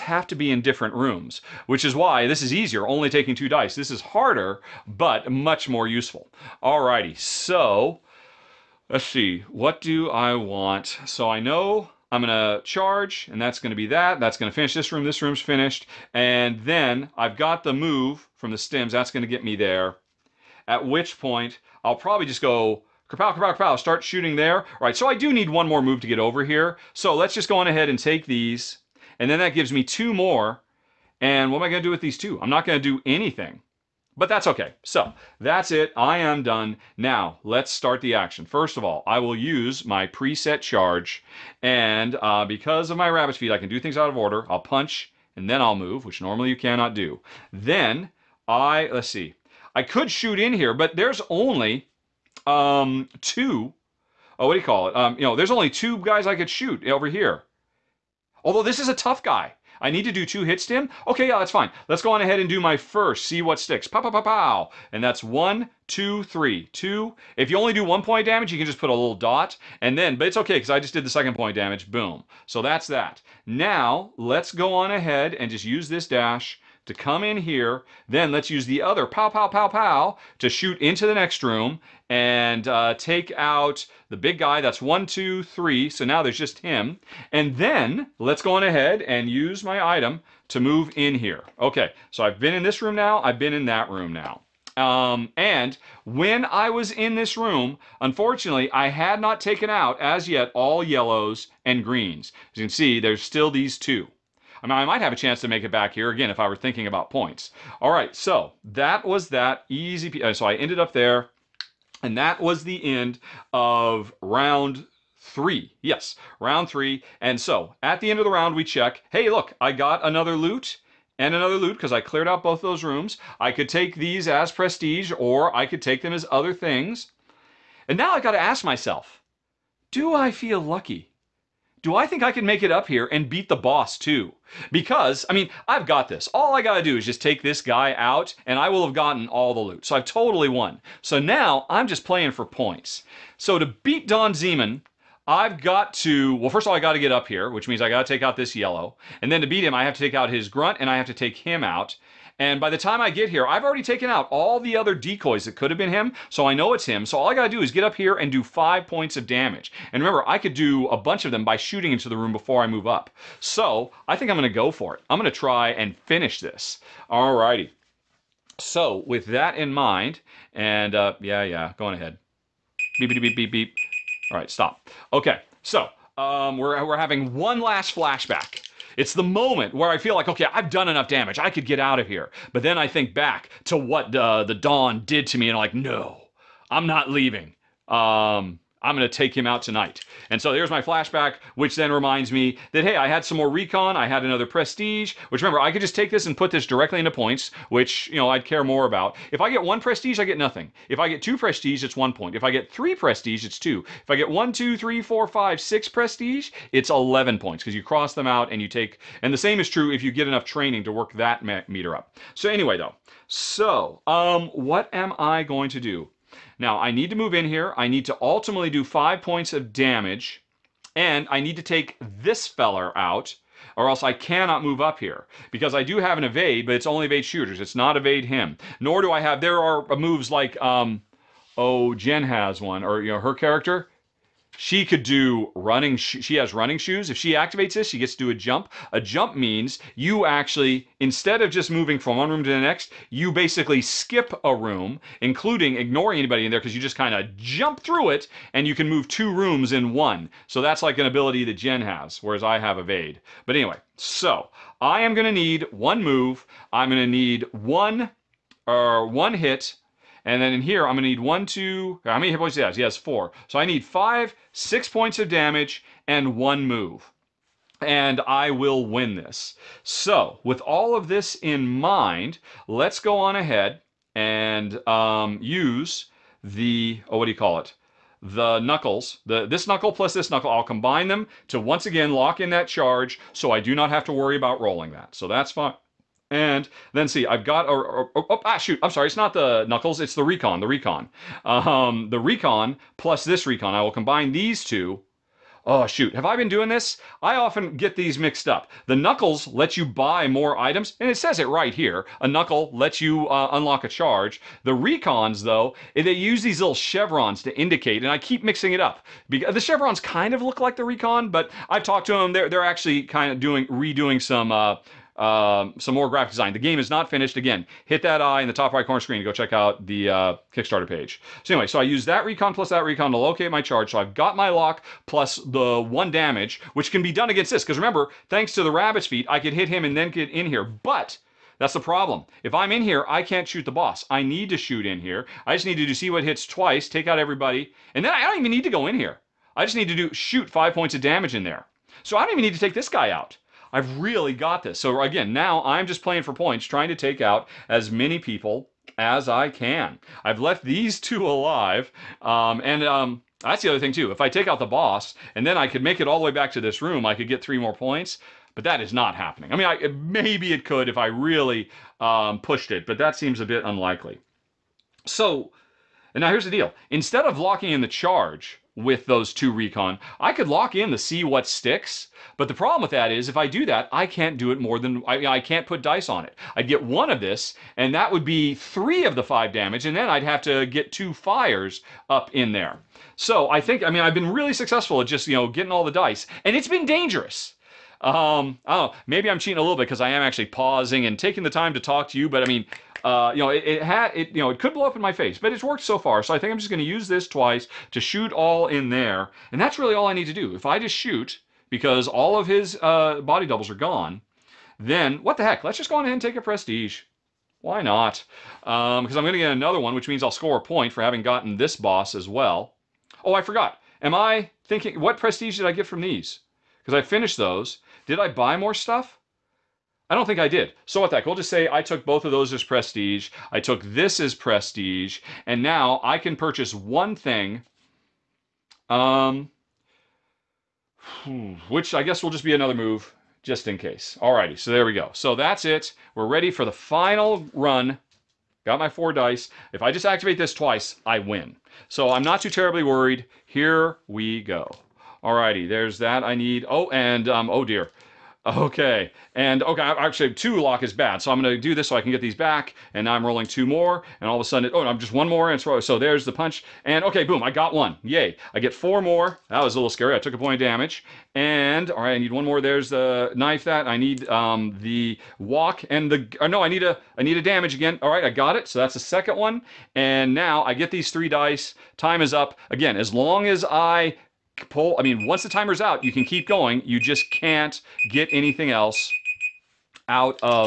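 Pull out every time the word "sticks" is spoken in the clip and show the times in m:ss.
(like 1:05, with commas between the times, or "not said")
1:03, 6:11.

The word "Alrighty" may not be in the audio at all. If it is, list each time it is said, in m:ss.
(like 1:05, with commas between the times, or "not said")
0:06, 2:47, 7:14.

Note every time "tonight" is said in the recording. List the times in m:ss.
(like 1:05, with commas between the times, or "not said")
3:09.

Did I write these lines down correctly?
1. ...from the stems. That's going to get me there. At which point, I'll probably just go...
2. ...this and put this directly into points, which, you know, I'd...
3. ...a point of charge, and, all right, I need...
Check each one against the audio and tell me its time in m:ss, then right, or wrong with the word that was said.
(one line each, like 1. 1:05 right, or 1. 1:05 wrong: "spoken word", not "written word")
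1. 0:18 right
2. 3:16 right
3. 7:40 wrong: "damage", not "charge".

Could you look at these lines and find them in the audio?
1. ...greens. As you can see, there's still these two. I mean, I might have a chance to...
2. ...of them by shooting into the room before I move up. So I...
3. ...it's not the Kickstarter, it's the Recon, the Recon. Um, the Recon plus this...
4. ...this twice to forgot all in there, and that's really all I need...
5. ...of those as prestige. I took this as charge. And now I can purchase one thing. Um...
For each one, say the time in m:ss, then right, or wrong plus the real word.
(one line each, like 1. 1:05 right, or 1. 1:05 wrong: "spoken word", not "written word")
1. 1:41 right
2. 2:41 right
3. 4:49 wrong: "Knuckles", not "Kickstarter"
4. 6:37 wrong: "shoot", not "forgot"
5. 7:02 wrong: "prestige", not "charge".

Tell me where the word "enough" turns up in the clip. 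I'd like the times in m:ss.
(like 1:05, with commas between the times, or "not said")
3:00, 3:30.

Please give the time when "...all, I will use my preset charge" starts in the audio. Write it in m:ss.
0:38.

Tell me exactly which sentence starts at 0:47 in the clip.
Then I, let's see, I could shoot in here, but there's only um, two, oh, what do you call it?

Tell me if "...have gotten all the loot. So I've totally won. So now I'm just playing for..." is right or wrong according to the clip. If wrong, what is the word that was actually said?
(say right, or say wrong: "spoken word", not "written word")
right.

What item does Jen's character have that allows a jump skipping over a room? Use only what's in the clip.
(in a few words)
Running shoes.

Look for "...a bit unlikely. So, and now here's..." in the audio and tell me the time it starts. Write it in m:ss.
6:03.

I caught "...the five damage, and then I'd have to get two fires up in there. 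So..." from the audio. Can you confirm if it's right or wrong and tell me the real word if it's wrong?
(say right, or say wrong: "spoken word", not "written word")
right.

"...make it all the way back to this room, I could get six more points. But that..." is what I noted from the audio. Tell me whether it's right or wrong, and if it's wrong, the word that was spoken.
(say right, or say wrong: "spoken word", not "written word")
wrong: "three", not "six".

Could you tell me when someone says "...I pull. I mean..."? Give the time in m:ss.
7:53.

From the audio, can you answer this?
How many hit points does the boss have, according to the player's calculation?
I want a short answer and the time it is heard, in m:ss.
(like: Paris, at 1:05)
4, at 4:22.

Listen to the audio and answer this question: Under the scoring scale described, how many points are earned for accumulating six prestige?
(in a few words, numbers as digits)
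11.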